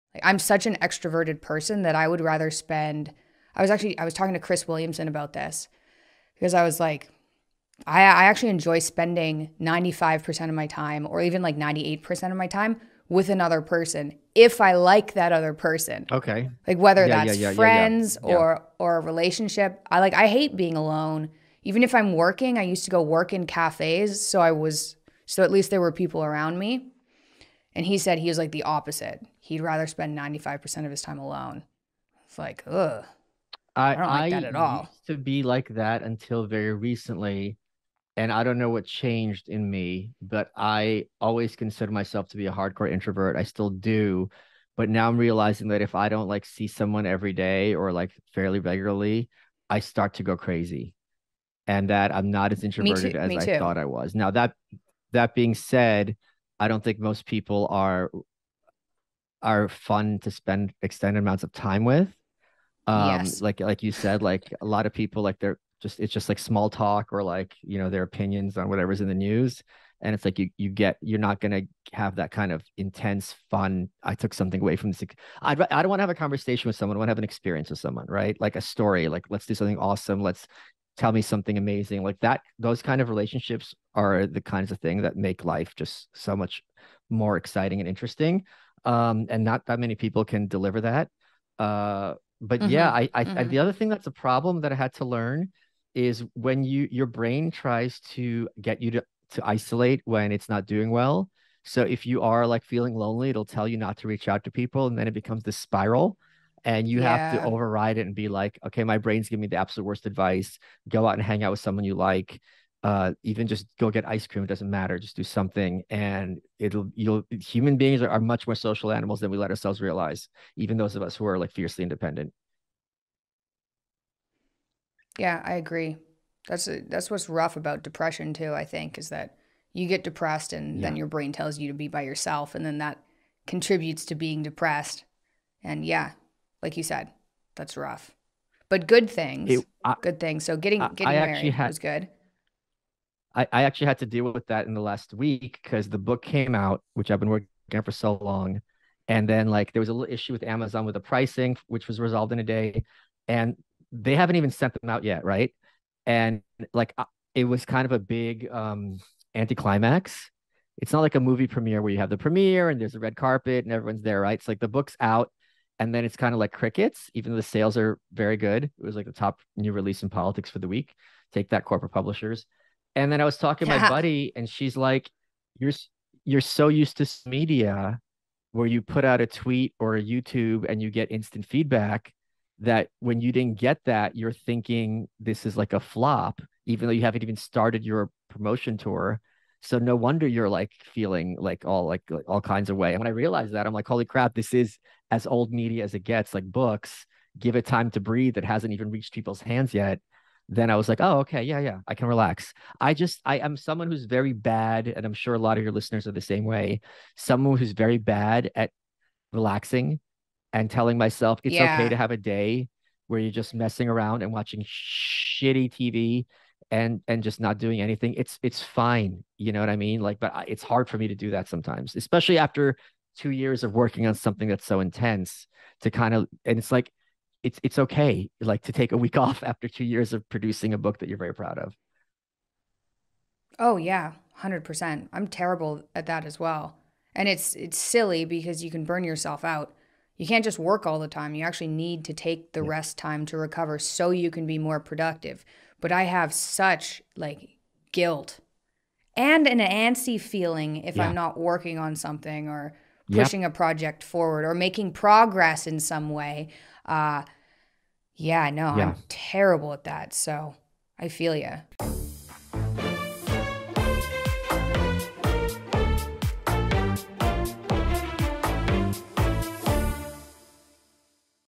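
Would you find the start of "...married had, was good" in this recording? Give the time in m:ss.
2:21.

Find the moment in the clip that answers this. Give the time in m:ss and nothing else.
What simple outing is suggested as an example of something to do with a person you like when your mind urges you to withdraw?
1:53.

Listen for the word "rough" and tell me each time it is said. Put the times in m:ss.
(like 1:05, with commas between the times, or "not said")
2:07, 2:17.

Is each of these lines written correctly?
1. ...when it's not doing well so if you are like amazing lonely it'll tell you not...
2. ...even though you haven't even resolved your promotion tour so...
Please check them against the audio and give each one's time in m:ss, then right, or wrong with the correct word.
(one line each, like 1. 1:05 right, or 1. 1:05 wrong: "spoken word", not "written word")
1. 1:40 wrong: "feeling", not "amazing"
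2. 3:06 wrong: "started", not "resolved".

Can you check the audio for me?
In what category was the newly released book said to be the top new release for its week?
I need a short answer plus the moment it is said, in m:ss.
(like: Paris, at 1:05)
politics, at 2:50.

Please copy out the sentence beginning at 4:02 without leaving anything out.
rest time to recover so you can be more productive but I have such like guilt and an antsy feeling if yeah.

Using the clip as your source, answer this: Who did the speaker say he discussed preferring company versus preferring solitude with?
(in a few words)
Chris Williamson.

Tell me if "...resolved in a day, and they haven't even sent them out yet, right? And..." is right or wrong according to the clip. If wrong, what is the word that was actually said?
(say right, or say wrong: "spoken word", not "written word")
right.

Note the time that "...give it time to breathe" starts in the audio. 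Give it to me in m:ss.
3:17.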